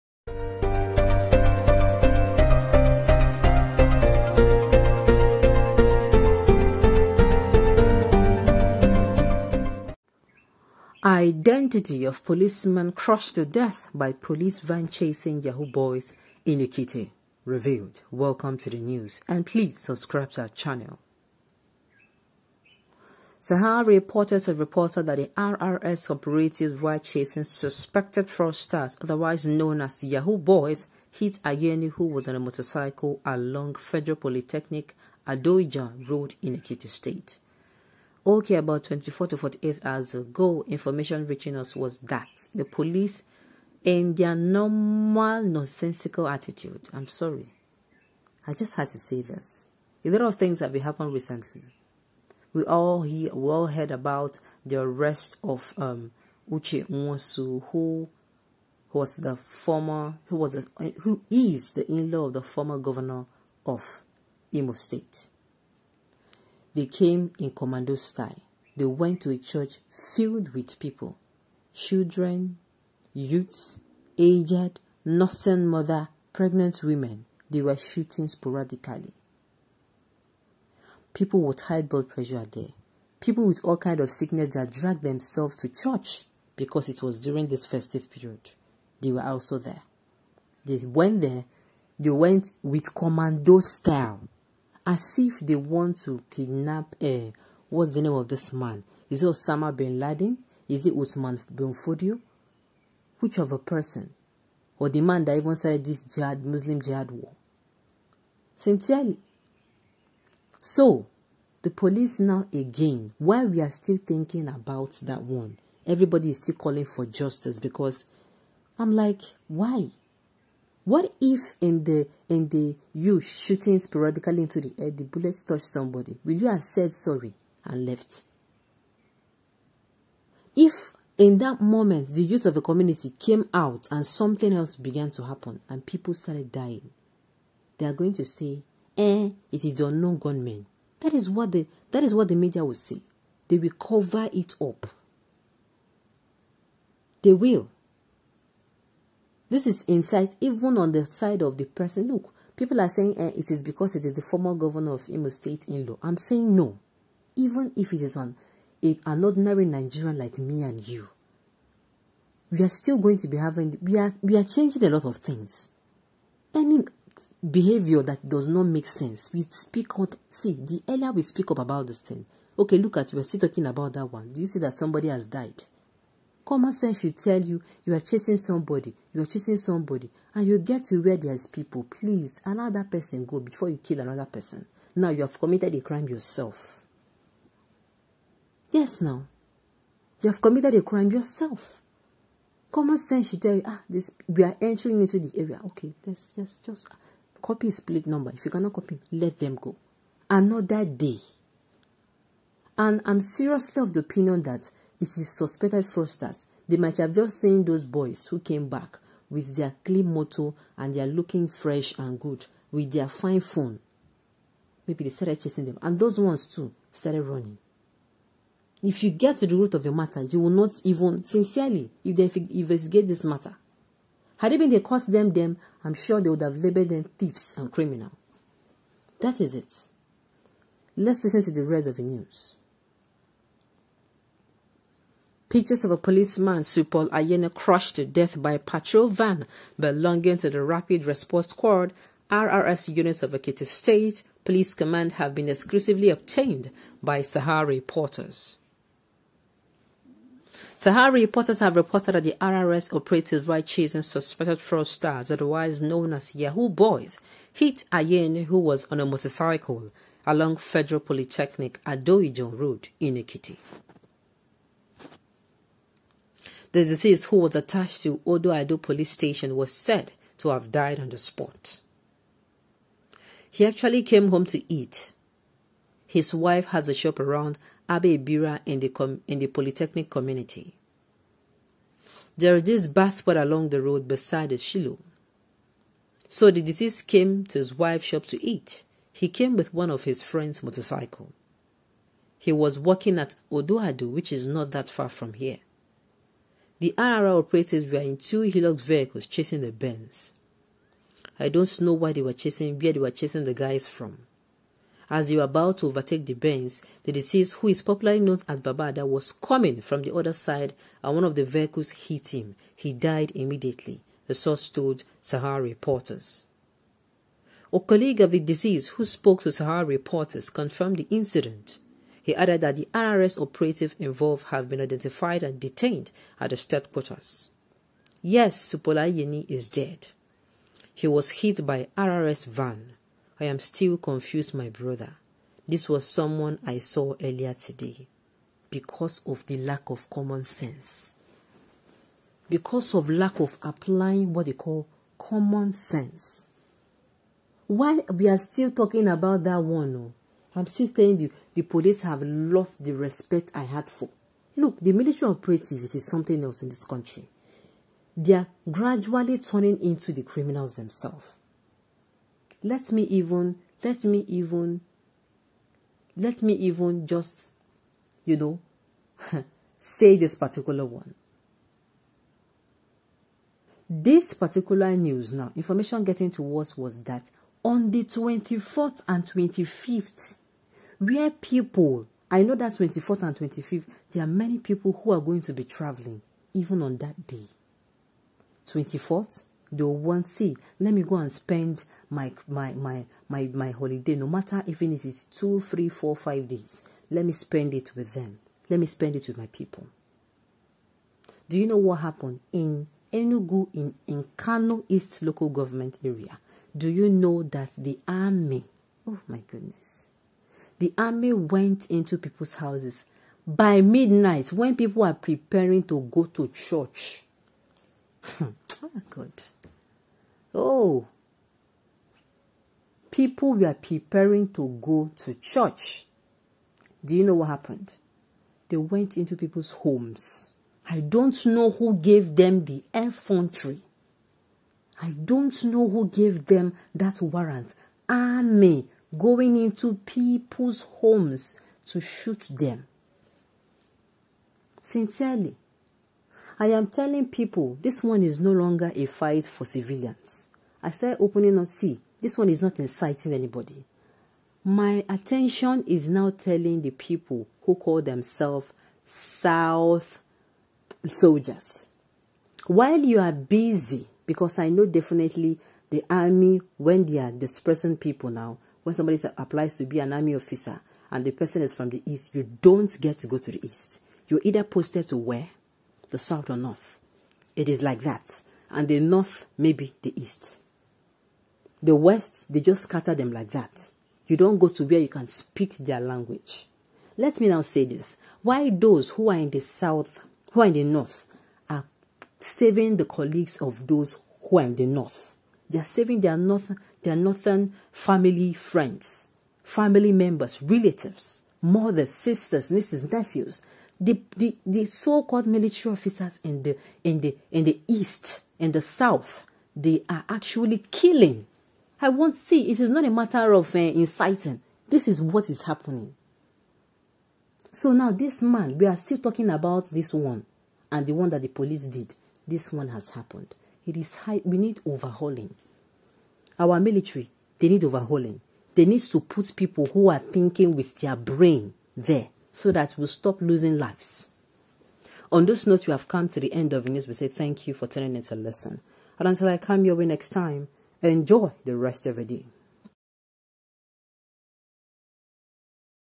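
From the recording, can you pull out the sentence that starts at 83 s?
People with all kind of sickness that dragged themselves to church because it was during this festive period.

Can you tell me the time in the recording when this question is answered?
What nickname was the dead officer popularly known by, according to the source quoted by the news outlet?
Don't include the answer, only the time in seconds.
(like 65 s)
308 s.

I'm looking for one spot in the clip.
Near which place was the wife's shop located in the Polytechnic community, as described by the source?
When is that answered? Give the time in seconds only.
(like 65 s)
277 s.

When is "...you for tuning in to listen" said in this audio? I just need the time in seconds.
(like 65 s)
537 s.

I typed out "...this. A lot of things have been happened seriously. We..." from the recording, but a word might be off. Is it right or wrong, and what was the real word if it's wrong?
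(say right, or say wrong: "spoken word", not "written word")
wrong: "recently", not "seriously".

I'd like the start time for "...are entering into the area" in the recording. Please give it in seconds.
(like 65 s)
194 s.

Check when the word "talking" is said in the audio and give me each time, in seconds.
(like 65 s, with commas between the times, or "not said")
173 s, 348 s, 519 s.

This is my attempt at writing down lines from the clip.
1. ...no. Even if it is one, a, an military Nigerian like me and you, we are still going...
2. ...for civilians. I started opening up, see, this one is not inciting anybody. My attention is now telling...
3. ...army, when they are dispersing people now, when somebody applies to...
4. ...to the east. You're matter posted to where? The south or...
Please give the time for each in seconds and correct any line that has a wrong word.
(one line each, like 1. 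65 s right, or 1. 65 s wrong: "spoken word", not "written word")
1. 156 s wrong: "ordinary", not "military"
2. 449 s right
3. 466 s right
4. 473 s wrong: "either", not "matter".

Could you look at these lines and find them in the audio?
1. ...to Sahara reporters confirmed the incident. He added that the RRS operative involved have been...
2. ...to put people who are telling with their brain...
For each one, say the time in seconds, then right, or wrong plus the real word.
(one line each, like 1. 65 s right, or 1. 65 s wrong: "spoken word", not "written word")
1. 319 s right
2. 529 s wrong: "thinking", not "telling".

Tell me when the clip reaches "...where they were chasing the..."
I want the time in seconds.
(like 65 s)
302 s.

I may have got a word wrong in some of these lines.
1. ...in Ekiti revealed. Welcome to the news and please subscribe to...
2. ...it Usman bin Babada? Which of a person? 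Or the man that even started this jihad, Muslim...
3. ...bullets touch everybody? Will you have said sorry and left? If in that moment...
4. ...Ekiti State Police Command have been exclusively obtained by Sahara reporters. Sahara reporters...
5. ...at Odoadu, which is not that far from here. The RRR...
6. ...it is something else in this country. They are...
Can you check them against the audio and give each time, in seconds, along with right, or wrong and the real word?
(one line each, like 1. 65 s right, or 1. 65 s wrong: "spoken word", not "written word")
1. 16 s right
2. 100 s wrong: "Fodio", not "Babada"
3. 125 s wrong: "somebody", not "everybody"
4. 243 s right
5. 293 s right
6. 355 s right.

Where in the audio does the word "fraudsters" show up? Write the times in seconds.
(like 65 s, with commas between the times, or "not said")
28 s, 205 s, 254 s.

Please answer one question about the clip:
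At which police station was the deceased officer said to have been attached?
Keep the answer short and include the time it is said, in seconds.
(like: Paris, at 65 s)
Odo Ado police station, at 268 s.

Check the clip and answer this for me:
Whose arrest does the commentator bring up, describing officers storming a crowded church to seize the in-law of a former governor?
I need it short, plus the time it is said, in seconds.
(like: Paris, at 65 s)
Uche Nwosu, at 56 s.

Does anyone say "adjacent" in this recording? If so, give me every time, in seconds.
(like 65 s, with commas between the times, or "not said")
not said.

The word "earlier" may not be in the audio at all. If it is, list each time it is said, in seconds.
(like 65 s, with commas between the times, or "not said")
170 s, 337 s.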